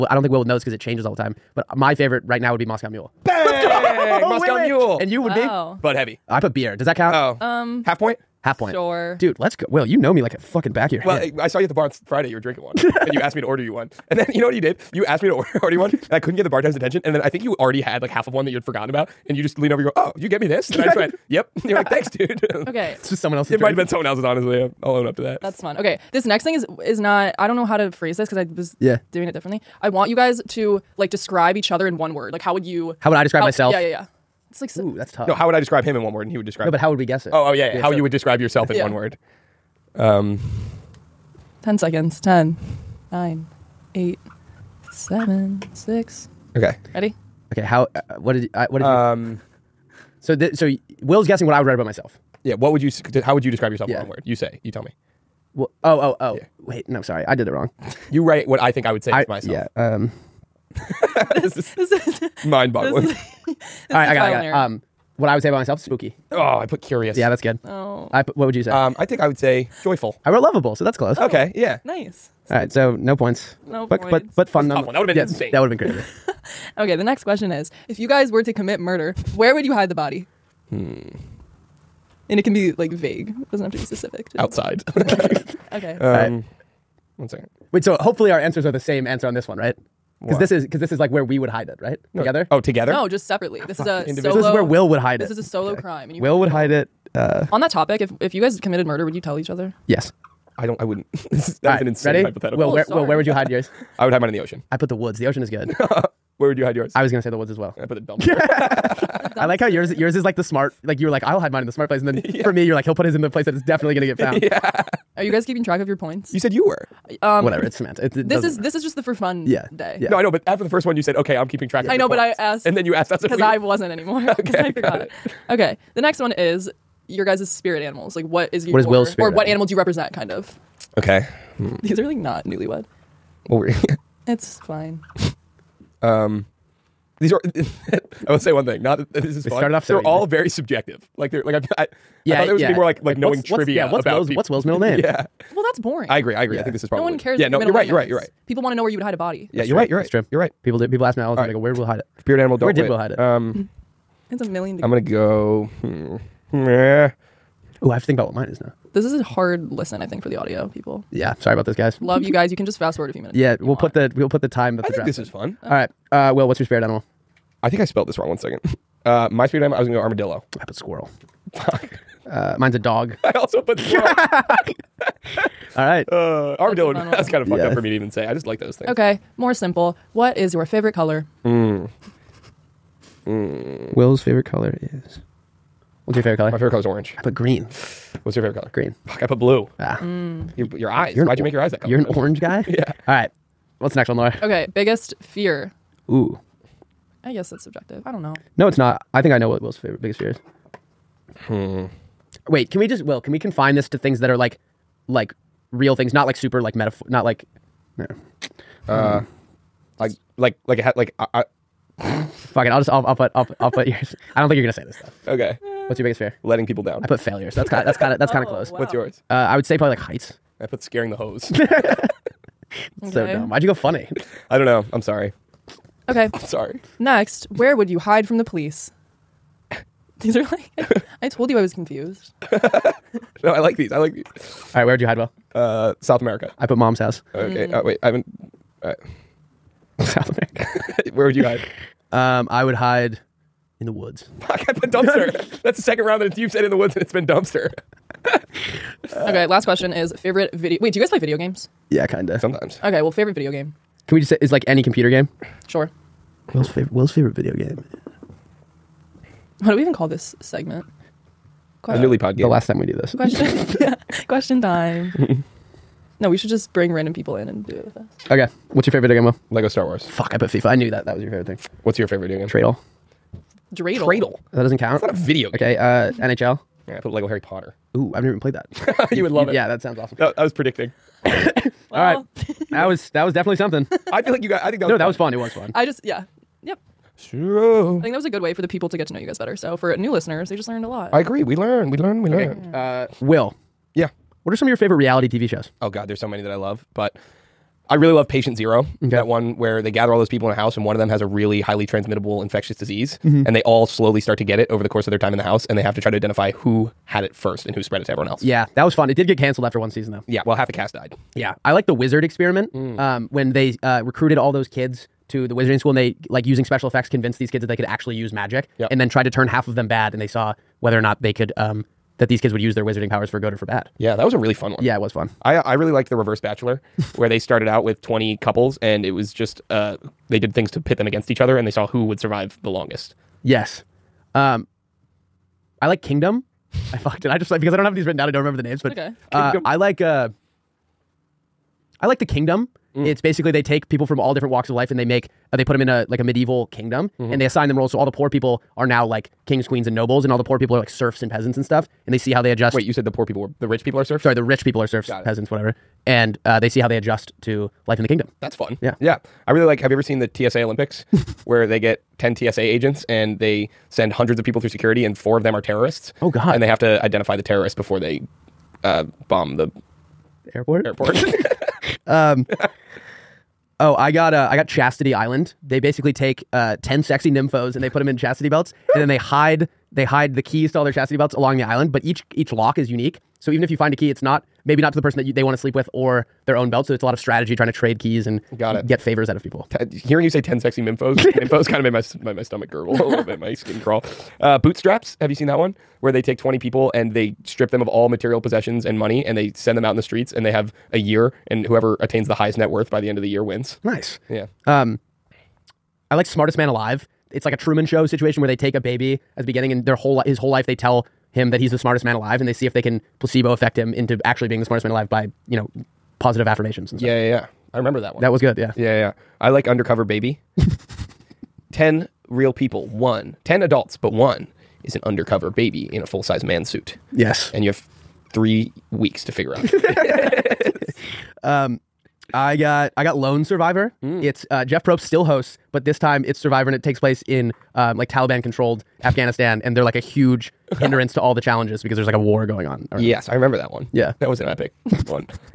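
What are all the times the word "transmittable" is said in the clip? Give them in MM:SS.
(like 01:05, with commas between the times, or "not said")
05:01.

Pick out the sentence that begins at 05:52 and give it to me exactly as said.
Wait, you said the poor people were the rich people are serfs.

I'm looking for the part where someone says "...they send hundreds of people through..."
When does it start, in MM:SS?
06:03.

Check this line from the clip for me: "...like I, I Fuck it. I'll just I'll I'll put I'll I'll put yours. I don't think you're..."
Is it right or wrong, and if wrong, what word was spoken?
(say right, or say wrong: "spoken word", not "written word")
right.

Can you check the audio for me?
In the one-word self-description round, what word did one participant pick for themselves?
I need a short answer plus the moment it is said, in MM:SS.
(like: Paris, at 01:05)
joyful, at 01:09.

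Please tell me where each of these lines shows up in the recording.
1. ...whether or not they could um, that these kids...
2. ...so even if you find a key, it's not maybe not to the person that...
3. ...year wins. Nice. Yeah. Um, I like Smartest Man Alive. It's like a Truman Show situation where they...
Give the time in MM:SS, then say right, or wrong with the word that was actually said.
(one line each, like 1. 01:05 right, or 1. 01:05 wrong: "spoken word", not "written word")
1. 05:20 right
2. 06:23 right
3. 06:43 right.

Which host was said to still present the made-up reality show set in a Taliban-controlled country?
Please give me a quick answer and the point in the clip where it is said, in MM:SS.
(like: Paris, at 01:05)
Jeff Probst, at 07:14.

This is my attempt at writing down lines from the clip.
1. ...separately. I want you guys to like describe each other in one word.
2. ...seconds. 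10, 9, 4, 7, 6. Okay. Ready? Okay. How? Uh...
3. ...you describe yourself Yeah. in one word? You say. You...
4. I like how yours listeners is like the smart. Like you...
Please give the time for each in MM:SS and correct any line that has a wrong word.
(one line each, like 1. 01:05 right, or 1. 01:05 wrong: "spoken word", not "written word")
1. 00:29 wrong: "differently", not "separately"
2. 00:41 wrong: "8", not "4"
3. 00:53 right
4. 01:49 wrong: "yours", not "listeners".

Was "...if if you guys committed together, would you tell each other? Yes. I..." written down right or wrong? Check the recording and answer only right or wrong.
wrong.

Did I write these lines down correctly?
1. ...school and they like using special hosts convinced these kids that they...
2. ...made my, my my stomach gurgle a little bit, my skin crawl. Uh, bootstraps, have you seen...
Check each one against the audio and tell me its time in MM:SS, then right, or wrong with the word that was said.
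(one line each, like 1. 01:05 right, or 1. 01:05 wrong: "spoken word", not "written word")
1. 05:15 wrong: "effects", not "hosts"
2. 06:31 right.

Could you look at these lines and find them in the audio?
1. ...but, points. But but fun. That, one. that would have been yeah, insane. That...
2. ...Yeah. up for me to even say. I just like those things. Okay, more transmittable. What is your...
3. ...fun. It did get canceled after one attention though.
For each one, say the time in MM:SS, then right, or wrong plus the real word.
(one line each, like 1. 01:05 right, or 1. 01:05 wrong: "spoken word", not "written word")
1. 01:13 right
2. 02:57 wrong: "simple", not "transmittable"
3. 05:08 wrong: "season", not "attention".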